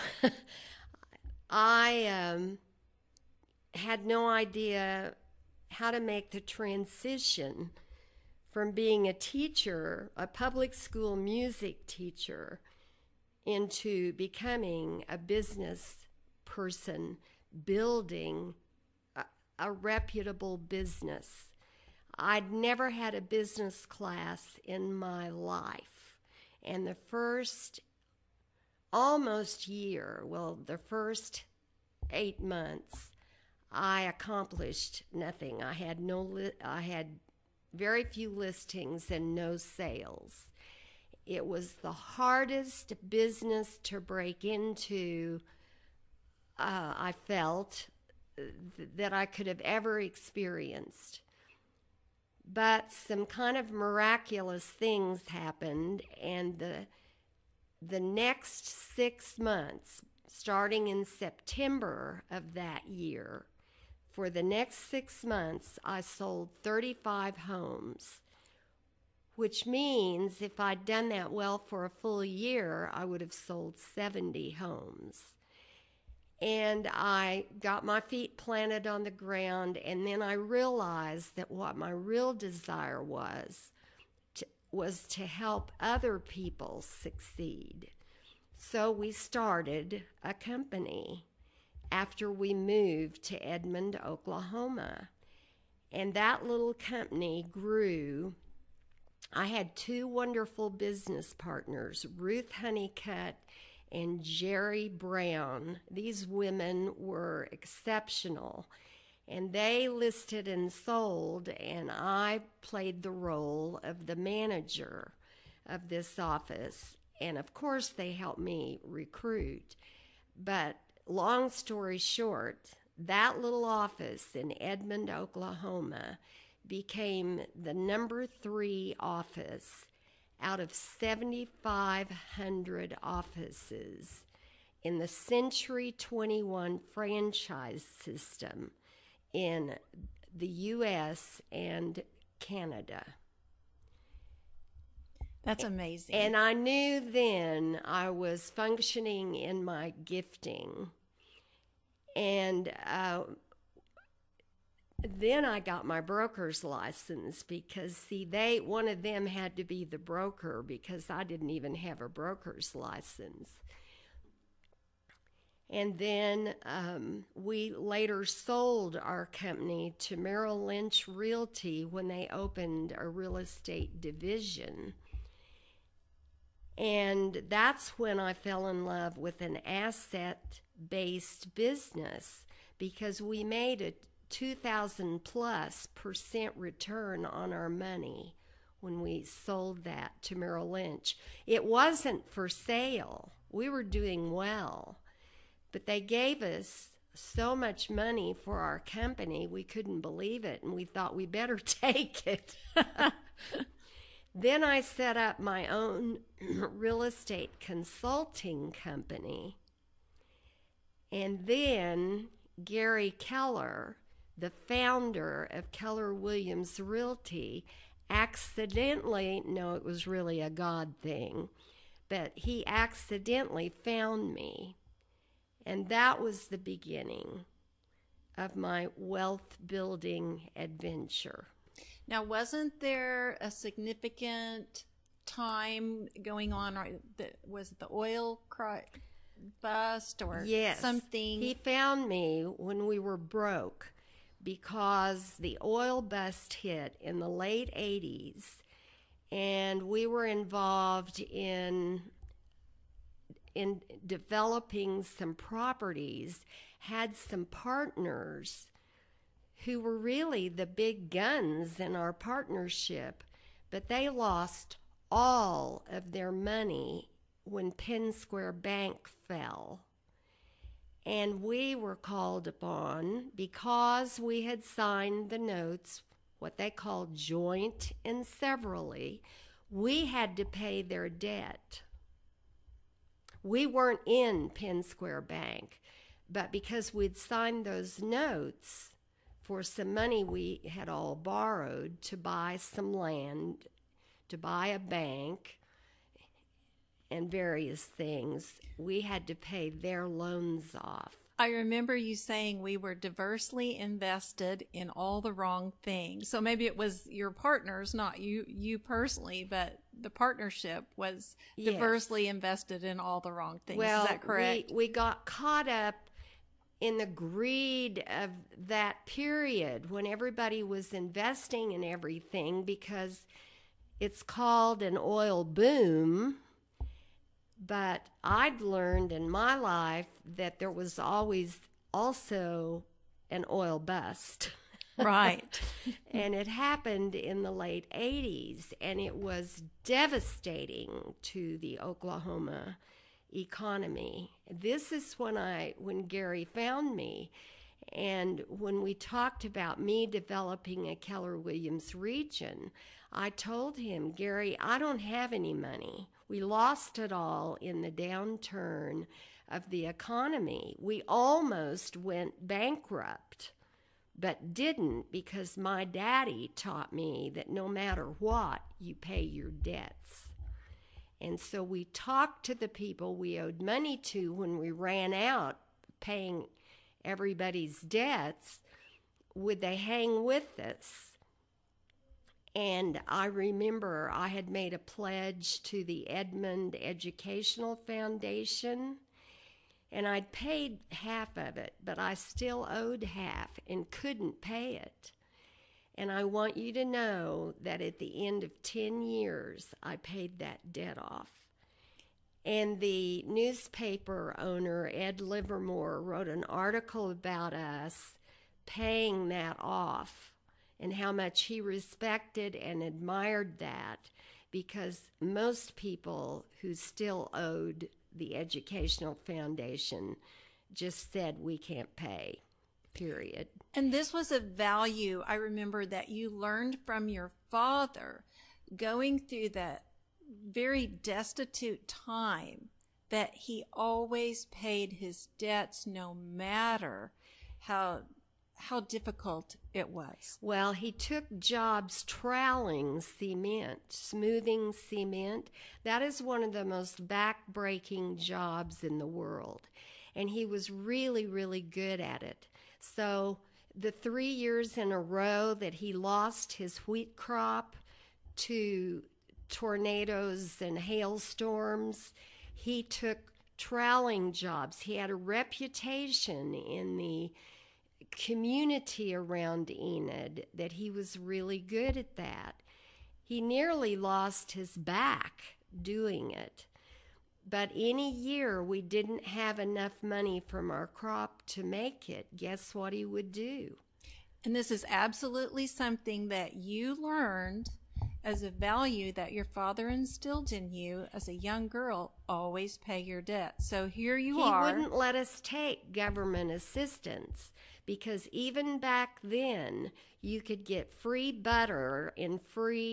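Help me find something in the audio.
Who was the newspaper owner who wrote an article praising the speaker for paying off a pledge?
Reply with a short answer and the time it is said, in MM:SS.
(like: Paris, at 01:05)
Ed Livermore, at 06:44.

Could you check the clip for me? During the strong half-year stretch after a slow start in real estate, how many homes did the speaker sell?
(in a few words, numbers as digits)
35.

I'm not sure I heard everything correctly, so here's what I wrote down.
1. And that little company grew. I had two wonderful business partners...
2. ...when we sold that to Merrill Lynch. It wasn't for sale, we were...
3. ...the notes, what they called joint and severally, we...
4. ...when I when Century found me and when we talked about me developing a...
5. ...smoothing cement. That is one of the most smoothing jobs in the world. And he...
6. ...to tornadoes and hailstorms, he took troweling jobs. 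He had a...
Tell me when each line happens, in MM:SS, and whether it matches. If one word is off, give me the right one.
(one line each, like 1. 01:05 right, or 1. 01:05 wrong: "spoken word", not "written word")
1. 01:35 right
2. 03:08 right
3. 04:35 right
4. 05:45 wrong: "Gary", not "Century"
5. 07:23 wrong: "backbreaking", not "smoothing"
6. 07:38 right.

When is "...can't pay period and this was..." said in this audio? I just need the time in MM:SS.
07:01.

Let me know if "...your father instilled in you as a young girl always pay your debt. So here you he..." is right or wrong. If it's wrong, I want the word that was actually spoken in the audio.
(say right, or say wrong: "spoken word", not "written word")
right.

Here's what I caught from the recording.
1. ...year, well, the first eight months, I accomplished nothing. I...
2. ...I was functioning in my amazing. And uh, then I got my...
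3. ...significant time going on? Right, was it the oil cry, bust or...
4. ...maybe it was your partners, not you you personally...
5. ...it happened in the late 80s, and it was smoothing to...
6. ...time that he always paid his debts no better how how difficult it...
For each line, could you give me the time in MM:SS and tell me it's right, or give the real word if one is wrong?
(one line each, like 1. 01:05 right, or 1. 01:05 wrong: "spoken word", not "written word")
1. 00:29 right
2. 02:27 wrong: "gifting", not "amazing"
3. 03:53 right
4. 05:06 right
5. 05:36 wrong: "devastating", not "smoothing"
6. 07:11 wrong: "matter", not "better".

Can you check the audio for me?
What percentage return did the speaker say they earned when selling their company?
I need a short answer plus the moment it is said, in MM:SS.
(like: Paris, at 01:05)
2,000 plus percent, at 03:04.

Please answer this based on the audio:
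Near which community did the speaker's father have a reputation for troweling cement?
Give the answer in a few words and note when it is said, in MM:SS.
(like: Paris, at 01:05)
Enid, at 07:49.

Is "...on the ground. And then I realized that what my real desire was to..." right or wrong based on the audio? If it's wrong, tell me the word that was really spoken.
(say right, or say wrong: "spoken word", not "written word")
right.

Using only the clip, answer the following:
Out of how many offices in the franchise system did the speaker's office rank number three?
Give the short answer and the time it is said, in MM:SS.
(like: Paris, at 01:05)
7,500, at 02:10.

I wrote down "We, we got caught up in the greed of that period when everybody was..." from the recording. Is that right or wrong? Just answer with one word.
right.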